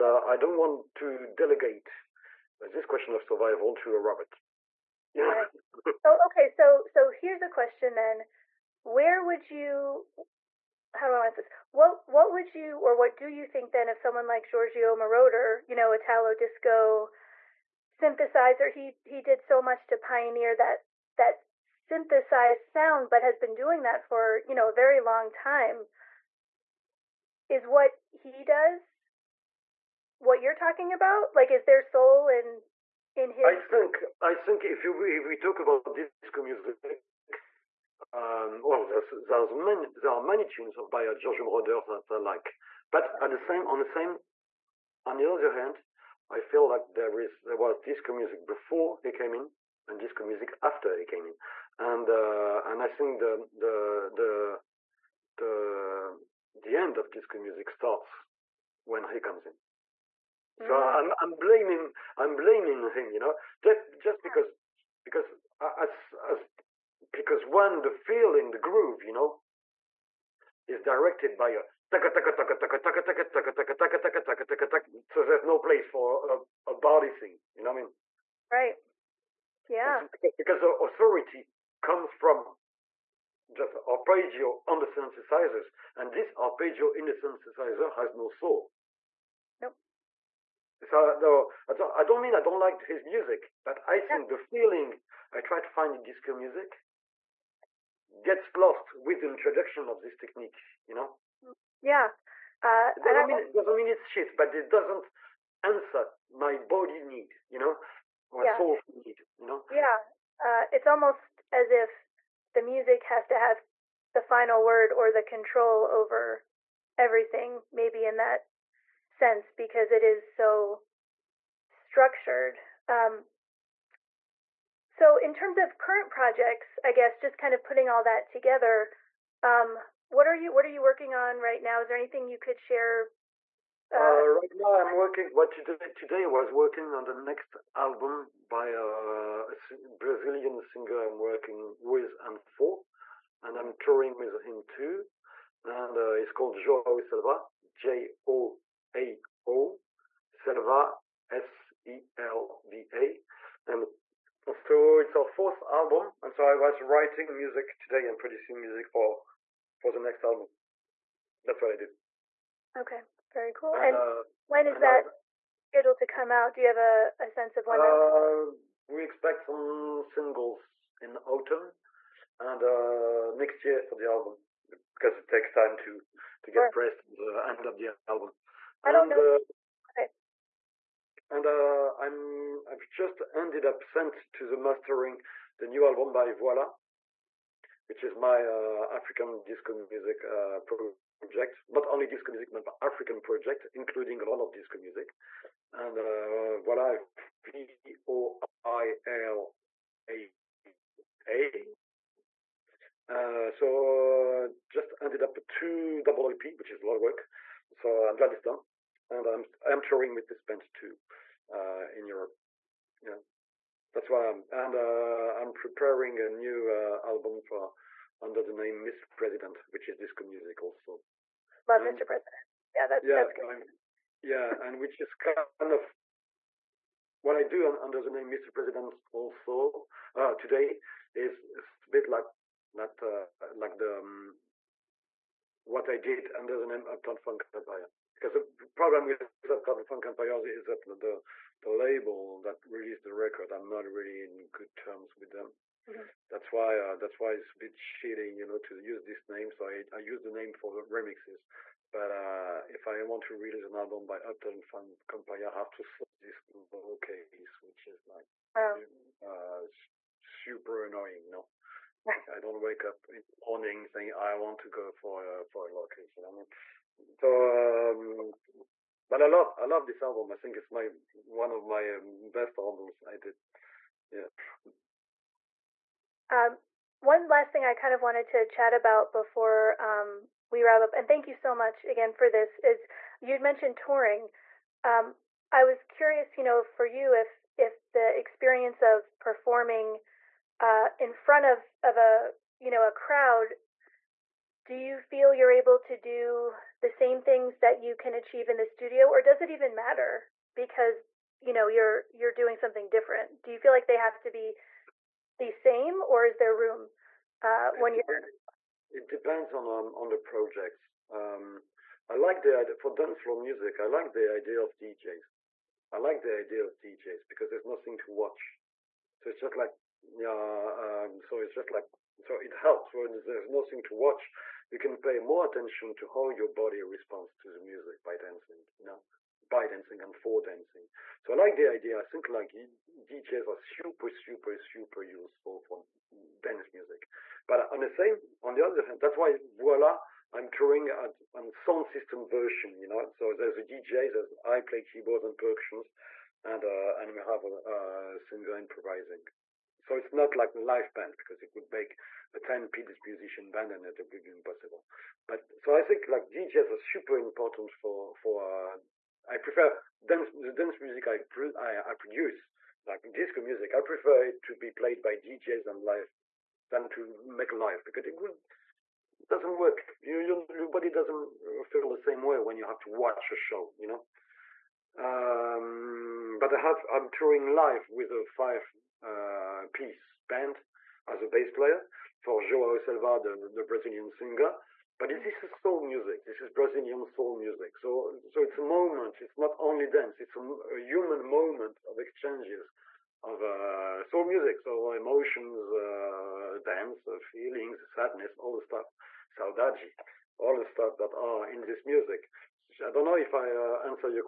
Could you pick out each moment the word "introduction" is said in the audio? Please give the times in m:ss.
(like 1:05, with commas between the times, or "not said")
1:39.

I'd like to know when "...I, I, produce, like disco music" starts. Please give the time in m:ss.
6:01.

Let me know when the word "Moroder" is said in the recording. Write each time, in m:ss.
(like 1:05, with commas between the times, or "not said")
0:14, 0:41.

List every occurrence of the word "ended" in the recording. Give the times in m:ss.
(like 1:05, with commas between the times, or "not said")
3:03, 3:24.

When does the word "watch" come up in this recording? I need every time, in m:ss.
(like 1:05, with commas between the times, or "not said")
5:18, 5:23, 6:12.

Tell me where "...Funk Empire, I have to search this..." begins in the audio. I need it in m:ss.
4:14.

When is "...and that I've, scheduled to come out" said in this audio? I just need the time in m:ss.
2:44.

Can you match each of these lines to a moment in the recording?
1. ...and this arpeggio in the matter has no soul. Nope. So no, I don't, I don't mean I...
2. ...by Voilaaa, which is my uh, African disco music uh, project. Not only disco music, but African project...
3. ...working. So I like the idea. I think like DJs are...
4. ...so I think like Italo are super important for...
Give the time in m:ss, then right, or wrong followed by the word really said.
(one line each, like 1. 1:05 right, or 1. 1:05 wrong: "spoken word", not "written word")
1. 1:25 wrong: "synthesizer", not "matter"
2. 3:06 right
3. 5:30 wrong: "dancing", not "working"
4. 5:55 wrong: "DJs", not "Italo".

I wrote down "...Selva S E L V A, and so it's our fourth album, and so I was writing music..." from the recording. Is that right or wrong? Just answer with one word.
right.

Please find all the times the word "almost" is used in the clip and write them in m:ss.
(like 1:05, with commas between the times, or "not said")
1:50.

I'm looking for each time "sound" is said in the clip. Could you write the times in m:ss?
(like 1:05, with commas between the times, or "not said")
0:22, 5:41.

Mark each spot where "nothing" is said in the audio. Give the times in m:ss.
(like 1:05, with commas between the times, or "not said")
5:17, 5:23.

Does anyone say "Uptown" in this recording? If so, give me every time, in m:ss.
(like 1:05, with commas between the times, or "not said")
3:56, 4:14.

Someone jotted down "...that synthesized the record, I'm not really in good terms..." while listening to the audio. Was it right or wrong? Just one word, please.
wrong.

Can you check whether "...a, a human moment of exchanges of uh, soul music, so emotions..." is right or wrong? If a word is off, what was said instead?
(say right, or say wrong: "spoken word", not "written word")
right.